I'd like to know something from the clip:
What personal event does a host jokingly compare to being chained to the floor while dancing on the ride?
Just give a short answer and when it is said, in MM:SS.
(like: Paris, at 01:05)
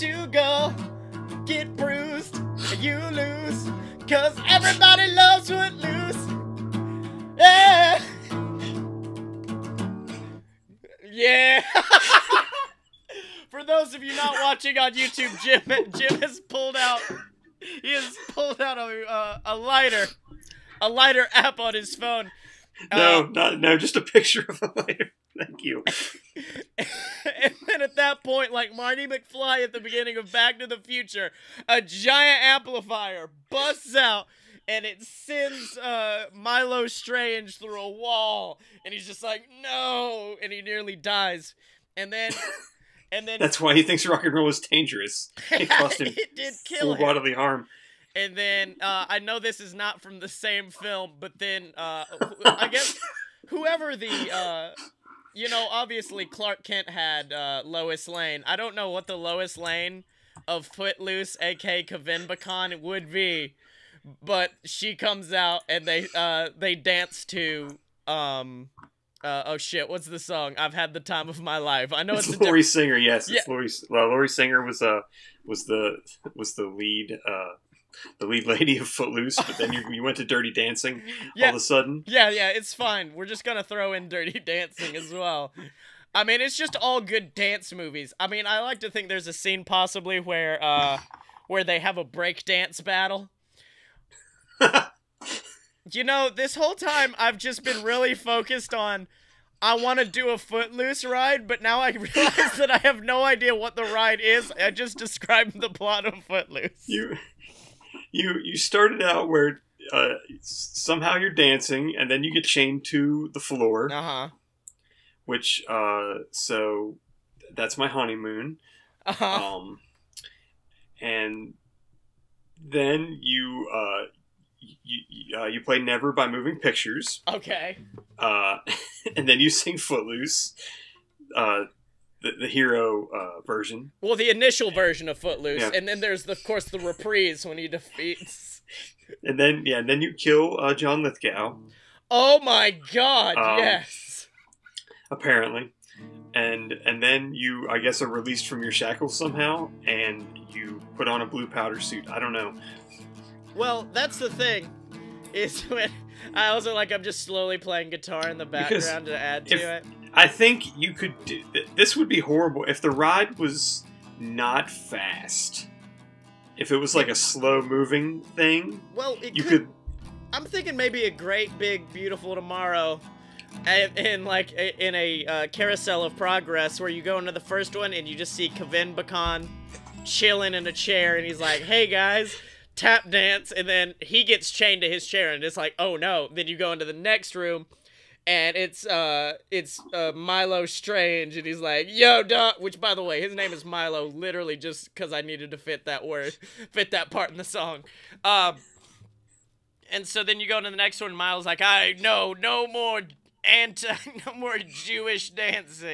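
honeymoon, at 01:57.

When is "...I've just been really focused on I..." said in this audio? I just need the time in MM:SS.
01:37.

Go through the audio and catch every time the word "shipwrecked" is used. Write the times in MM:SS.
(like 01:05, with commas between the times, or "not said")
not said.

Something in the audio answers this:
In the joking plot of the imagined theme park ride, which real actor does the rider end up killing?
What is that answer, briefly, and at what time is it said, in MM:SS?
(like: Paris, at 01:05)
John Lithgow, at 02:20.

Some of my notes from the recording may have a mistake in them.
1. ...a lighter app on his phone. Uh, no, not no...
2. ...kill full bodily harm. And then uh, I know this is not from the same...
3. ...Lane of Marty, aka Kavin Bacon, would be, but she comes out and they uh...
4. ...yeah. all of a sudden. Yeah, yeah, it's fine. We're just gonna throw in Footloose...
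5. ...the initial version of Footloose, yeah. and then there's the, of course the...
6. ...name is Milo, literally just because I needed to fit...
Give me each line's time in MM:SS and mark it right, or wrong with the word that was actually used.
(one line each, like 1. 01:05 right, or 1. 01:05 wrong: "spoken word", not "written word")
1. 00:20 right
2. 00:46 right
3. 00:59 wrong: "Footloose", not "Marty"
4. 01:21 wrong: "Dirty", not "Footloose"
5. 02:14 right
6. 03:13 right.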